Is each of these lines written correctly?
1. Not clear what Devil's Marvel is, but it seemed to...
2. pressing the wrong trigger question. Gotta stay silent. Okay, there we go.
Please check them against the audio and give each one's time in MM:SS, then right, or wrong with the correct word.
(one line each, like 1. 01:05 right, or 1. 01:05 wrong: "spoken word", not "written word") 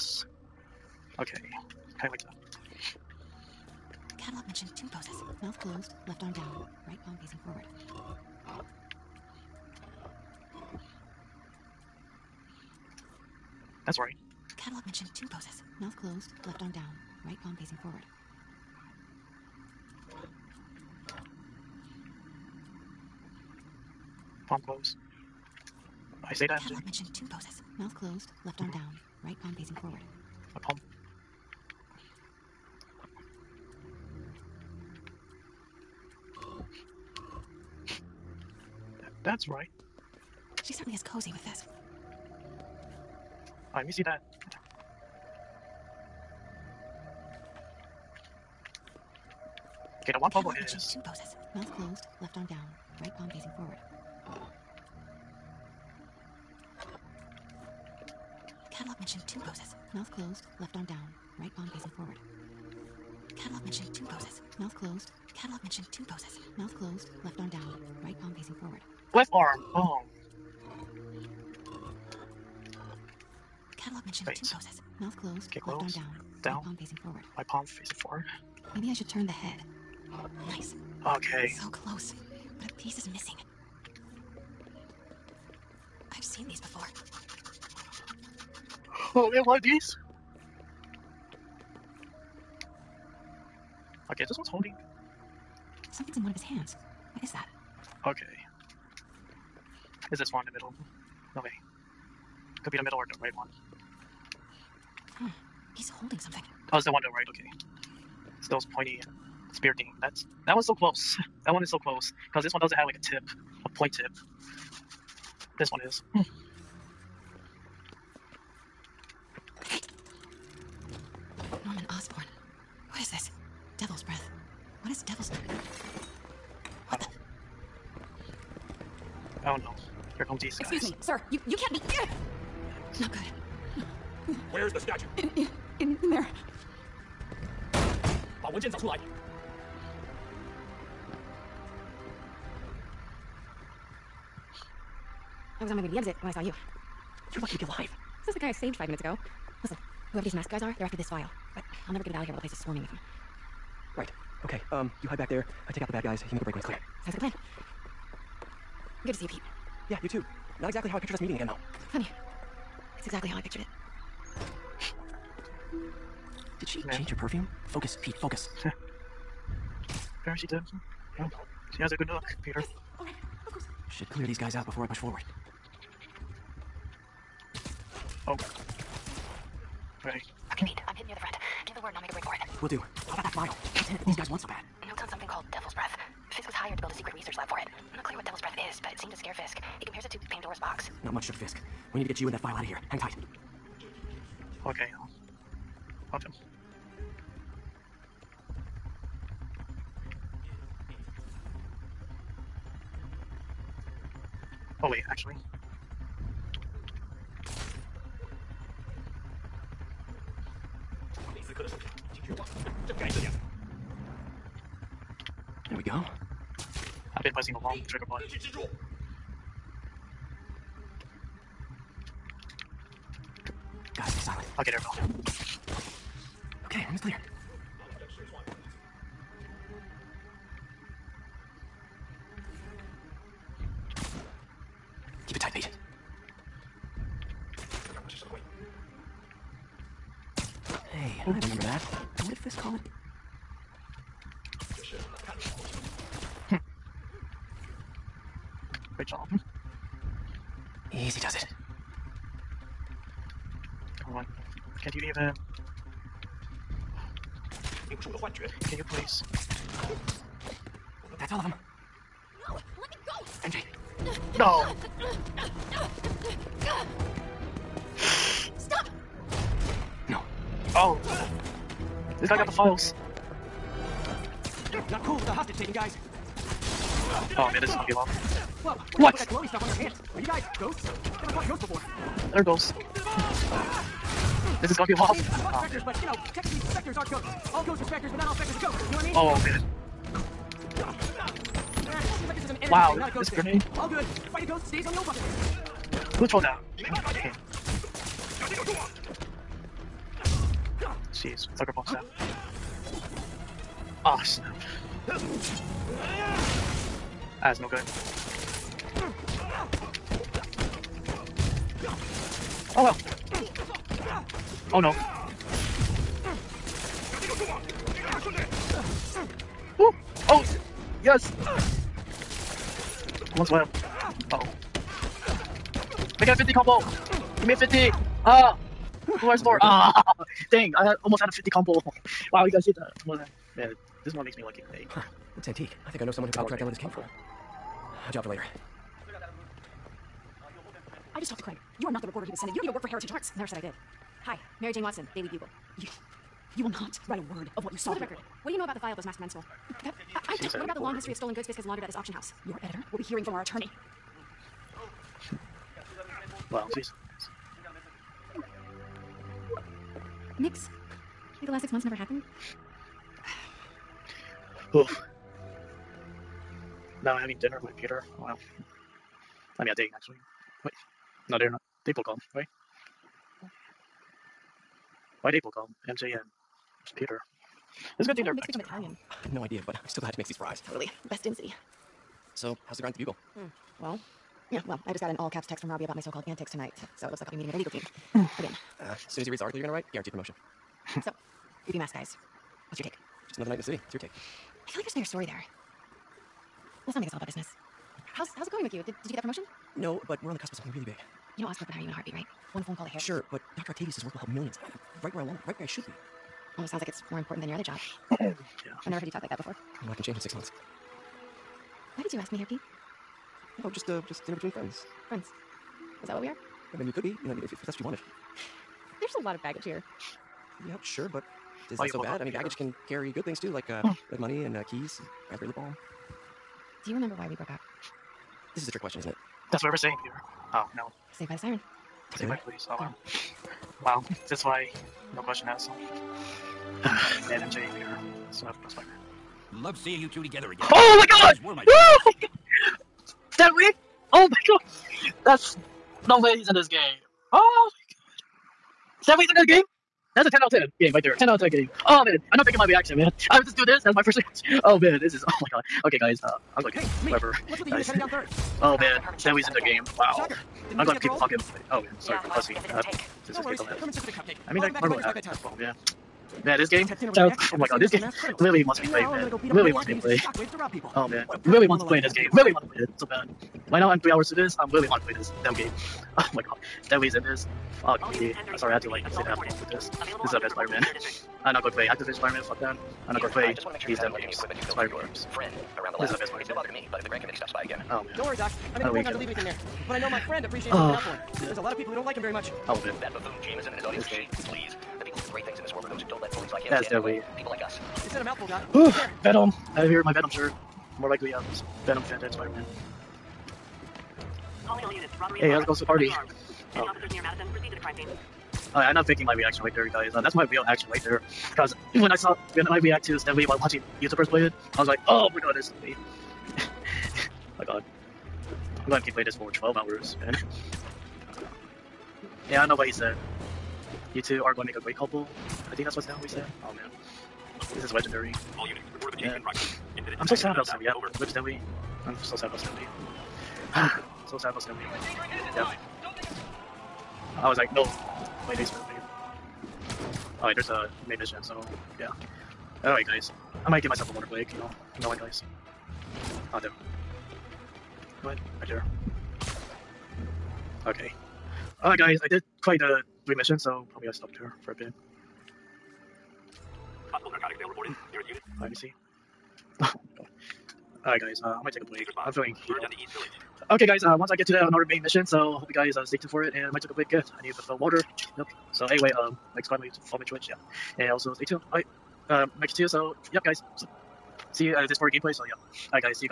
1. 03:07 wrong: "Breath", not "Marvel"
2. 03:37 wrong: "button", not "question".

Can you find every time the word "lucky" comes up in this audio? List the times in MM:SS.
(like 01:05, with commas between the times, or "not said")
02:27.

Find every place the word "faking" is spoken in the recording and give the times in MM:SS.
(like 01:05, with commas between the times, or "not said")
07:32, 08:29.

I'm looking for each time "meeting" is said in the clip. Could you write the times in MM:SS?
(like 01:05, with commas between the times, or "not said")
02:41, 06:27.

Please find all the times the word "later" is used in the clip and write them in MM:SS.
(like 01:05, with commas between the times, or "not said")
05:38.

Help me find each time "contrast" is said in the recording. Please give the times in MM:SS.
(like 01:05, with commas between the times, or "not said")
not said.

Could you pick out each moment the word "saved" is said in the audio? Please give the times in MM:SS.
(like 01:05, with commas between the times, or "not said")
02:28, 07:11.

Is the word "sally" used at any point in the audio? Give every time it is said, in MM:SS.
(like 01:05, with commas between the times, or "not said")
not said.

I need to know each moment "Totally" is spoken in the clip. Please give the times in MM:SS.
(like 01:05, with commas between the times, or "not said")
06:20.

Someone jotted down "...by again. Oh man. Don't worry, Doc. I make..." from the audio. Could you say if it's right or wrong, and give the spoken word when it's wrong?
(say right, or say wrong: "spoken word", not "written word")
right.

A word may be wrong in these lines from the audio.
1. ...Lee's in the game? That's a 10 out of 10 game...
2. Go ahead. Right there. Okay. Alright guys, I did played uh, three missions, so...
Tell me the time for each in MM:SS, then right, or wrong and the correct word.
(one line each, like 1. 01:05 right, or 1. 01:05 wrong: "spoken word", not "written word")
1. 07:29 right
2. 09:08 right.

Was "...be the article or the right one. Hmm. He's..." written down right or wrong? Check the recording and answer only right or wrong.
wrong.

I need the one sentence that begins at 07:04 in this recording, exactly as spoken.
like money and uh, keys, and raspberry lip balm.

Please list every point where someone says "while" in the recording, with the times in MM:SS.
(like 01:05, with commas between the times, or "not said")
02:32, 08:33.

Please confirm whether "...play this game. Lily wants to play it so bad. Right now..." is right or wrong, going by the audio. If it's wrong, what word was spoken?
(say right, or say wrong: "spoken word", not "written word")
right.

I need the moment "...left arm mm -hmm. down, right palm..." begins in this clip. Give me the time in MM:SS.
00:28.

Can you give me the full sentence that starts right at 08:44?
You two are going to make a great couple.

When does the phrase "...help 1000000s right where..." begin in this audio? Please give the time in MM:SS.
06:44.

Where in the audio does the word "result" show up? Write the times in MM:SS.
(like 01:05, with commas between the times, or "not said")
not said.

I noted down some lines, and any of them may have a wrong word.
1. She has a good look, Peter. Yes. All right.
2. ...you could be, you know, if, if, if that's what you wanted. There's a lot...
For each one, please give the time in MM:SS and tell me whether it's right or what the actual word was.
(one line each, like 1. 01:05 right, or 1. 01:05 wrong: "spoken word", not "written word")
1. 02:51 right
2. 06:56 right.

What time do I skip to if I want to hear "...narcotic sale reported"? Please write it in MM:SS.
09:17.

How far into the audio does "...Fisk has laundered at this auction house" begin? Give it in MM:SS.
05:51.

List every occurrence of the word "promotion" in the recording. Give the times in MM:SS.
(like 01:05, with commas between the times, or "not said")
06:30, 06:39.